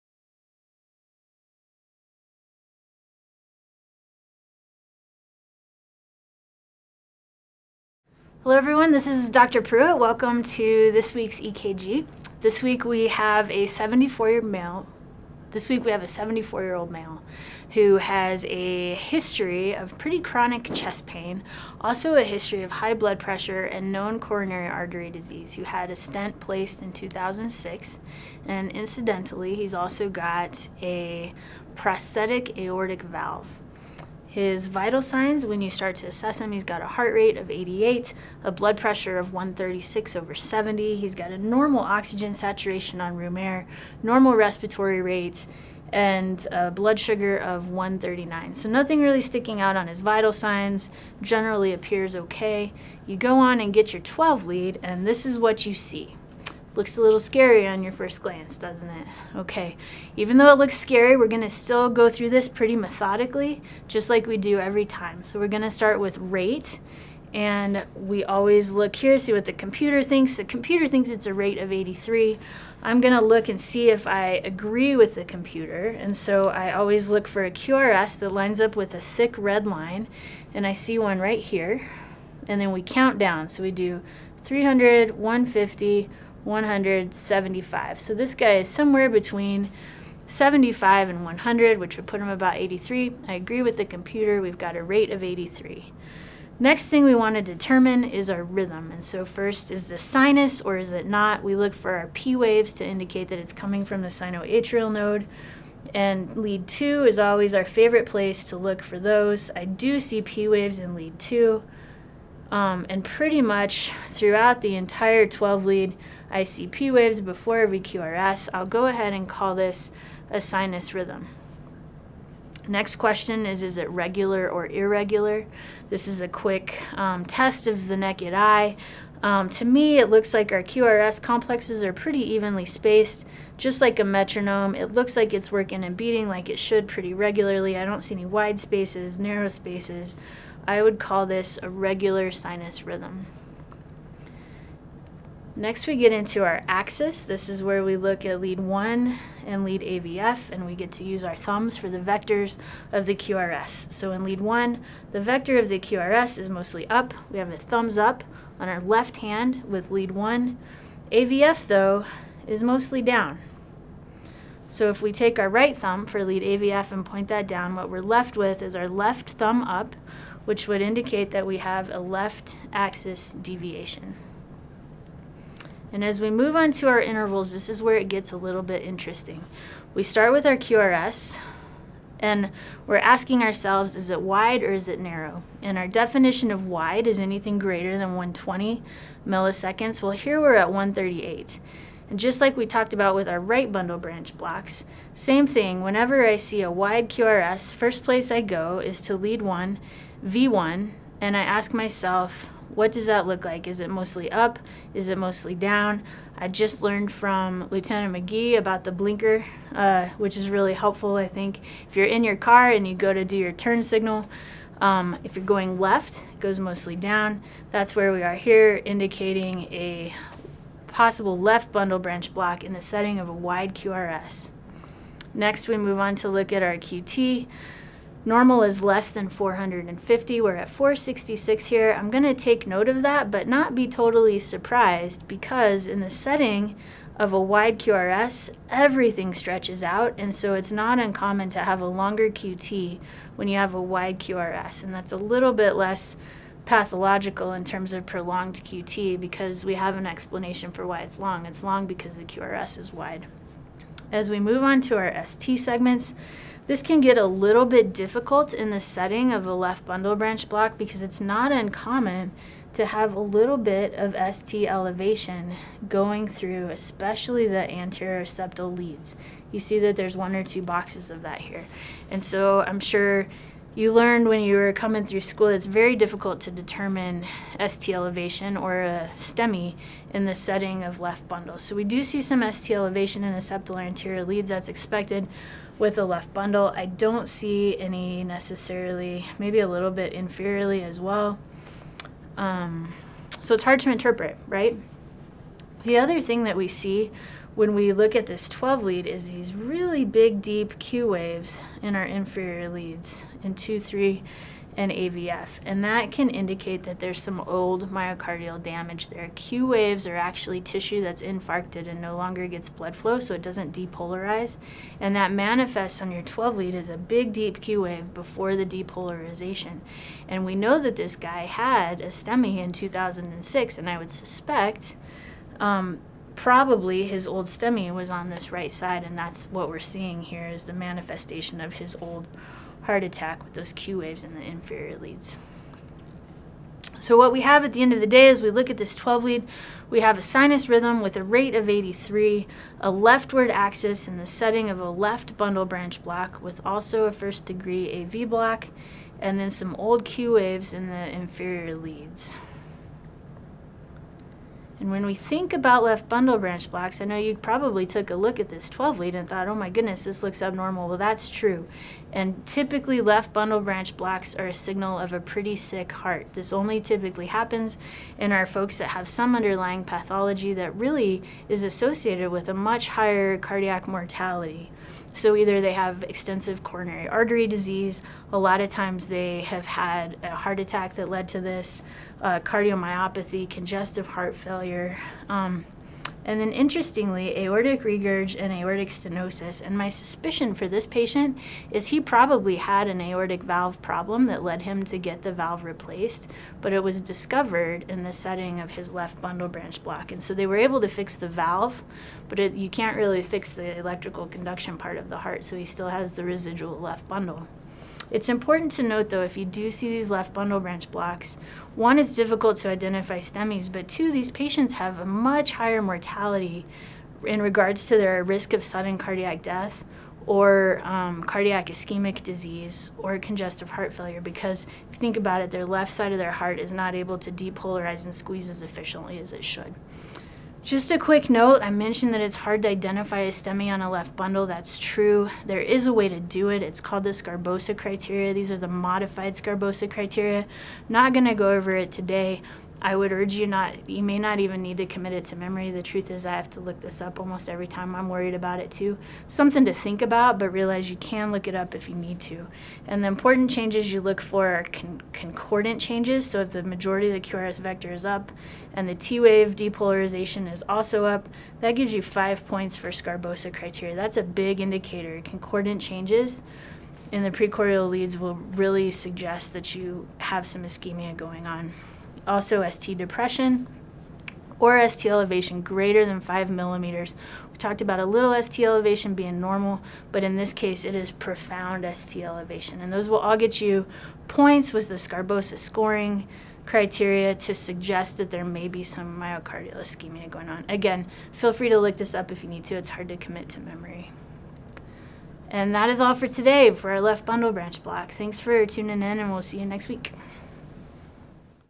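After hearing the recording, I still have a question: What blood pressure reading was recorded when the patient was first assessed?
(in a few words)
136/70.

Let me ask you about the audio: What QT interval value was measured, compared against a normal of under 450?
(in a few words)
466.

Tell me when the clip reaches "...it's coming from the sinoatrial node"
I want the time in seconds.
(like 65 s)
103 s.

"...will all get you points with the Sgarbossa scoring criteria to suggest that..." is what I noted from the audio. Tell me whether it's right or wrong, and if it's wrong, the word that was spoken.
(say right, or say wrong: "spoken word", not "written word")
right.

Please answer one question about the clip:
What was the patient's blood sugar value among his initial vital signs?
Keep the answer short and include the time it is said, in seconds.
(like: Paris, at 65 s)
139, at 47 s.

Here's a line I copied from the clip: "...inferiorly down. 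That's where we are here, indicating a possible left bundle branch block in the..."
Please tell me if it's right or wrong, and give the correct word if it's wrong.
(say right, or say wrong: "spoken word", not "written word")
wrong: "mostly", not "inferiorly".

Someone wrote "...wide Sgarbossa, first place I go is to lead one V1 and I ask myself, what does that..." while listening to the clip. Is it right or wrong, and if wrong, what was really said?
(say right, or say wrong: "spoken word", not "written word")
wrong: "QRS", not "Sgarbossa".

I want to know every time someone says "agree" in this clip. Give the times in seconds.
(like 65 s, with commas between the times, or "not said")
74 s, 93 s.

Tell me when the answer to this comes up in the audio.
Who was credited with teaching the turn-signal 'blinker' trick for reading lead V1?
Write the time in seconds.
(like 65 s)
207 s.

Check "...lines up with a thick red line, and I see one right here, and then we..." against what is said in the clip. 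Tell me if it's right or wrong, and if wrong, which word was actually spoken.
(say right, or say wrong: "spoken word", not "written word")
right.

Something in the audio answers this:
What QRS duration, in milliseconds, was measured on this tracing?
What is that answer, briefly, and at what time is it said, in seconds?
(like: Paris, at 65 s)
138, at 190 s.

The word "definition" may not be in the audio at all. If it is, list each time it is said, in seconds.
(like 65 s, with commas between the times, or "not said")
185 s.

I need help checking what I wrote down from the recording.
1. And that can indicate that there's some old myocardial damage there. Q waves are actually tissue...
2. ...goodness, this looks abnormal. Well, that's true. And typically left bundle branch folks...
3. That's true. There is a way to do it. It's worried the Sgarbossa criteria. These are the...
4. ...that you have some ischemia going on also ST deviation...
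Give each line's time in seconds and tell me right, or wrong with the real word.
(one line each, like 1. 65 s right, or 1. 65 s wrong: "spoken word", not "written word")
1. 305 s right
2. 359 s wrong: "blocks", not "folks"
3. 434 s wrong: "called", not "worried"
4. 469 s wrong: "depression", not "deviation".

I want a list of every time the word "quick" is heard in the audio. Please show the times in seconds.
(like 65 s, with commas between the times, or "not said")
126 s, 430 s.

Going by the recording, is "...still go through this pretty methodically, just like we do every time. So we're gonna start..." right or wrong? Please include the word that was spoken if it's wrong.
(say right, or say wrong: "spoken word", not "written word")
right.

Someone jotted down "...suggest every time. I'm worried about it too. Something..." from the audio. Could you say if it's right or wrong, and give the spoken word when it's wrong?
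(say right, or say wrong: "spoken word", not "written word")
wrong: "almost", not "suggest".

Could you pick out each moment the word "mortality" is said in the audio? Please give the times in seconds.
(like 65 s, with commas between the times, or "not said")
373 s, 415 s.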